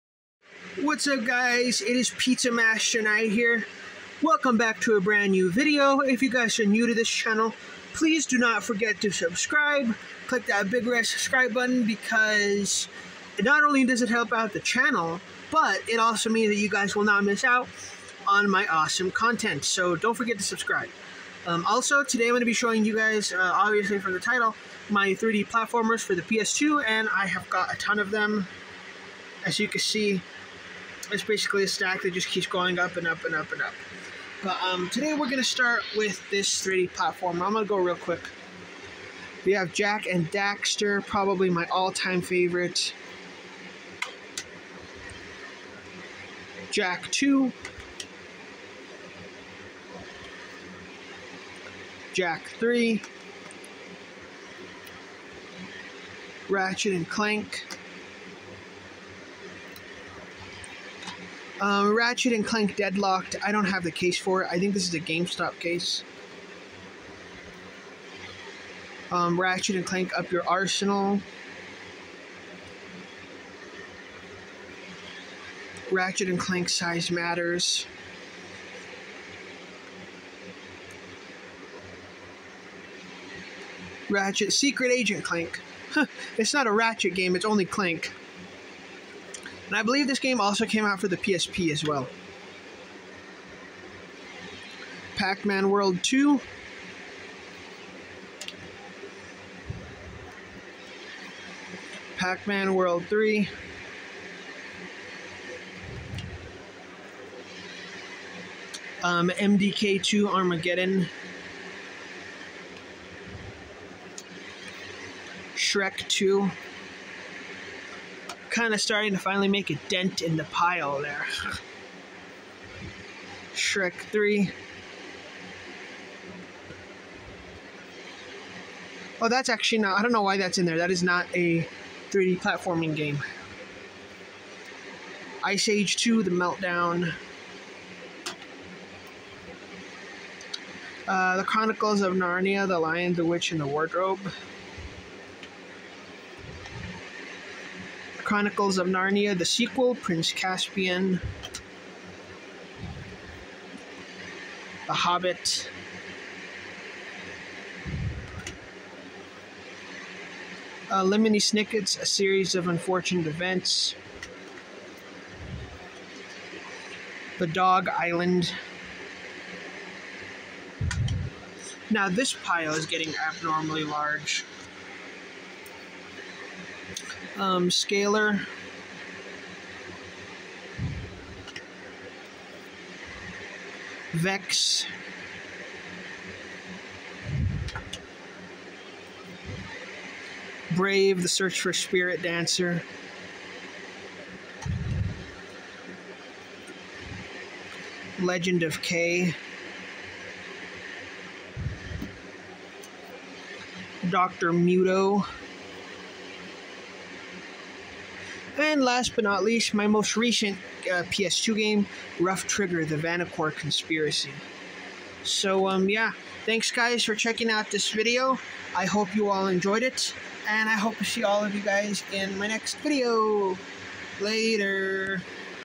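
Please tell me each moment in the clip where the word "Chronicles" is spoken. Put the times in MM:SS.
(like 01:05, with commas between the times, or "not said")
02:21, 02:28.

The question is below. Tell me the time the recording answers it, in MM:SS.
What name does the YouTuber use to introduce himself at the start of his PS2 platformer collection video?
00:02.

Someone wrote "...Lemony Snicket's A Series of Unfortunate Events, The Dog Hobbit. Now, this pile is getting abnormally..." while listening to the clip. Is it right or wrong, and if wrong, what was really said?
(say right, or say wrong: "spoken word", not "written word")
wrong: "Island", not "Hobbit".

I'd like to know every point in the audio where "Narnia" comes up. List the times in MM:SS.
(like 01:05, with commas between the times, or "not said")
02:22, 02:28.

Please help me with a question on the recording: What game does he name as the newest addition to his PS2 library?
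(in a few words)
Ruff Trigger.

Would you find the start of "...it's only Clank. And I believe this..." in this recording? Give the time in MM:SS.
01:27.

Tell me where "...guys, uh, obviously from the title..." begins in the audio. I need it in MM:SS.
00:22.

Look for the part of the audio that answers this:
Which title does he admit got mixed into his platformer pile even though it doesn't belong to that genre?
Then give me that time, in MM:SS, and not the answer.
02:03.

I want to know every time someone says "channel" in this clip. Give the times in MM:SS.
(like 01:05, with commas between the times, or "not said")
00:07, 00:14.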